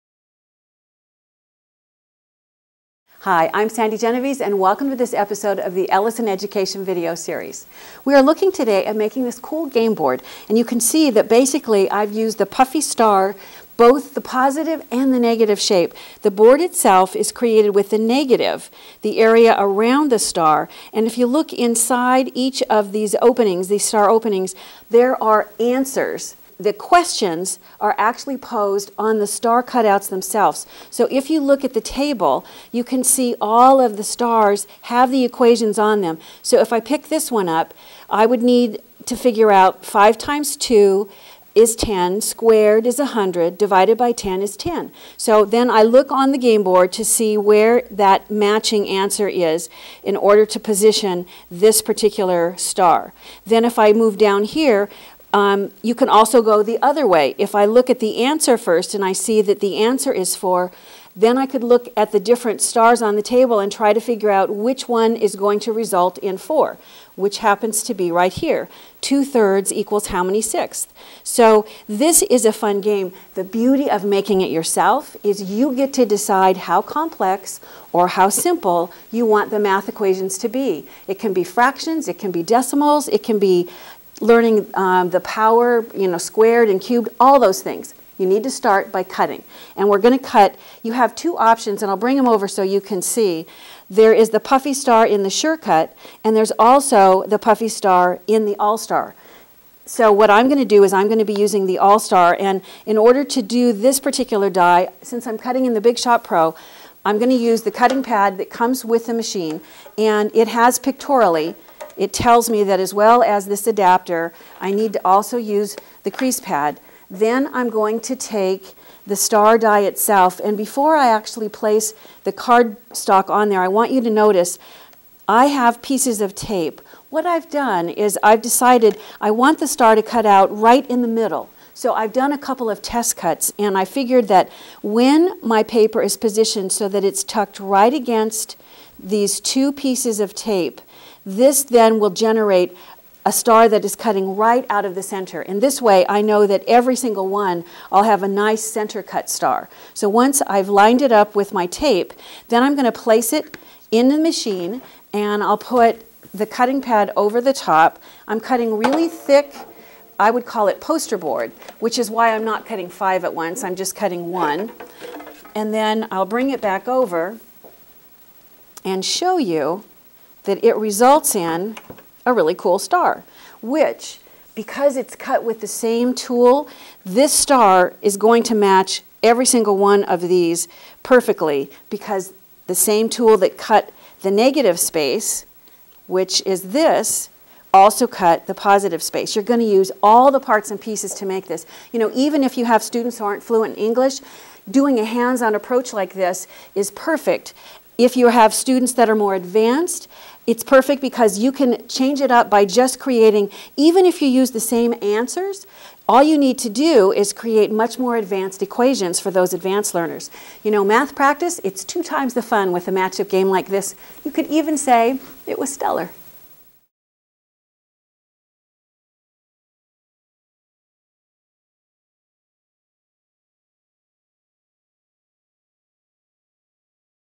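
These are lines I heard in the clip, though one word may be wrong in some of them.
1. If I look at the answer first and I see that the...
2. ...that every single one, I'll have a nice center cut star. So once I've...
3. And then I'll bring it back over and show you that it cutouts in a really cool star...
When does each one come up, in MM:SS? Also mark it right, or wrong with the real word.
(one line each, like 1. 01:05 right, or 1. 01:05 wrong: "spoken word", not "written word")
1. 00:57 right
2. 02:26 right
3. 02:45 wrong: "results", not "cutouts".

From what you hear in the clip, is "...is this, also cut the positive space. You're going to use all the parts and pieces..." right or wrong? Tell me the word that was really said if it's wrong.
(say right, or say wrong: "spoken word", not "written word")
right.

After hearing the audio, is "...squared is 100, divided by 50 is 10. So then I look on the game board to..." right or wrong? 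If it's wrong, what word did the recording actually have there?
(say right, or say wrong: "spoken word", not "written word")
wrong: "10", not "50".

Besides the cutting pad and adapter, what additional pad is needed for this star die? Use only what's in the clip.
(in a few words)
crease pad.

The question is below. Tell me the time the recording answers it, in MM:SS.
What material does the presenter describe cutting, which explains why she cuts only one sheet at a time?
02:40.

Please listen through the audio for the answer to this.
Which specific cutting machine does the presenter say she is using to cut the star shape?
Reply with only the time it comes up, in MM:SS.
01:45.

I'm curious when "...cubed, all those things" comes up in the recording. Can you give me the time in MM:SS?
01:26.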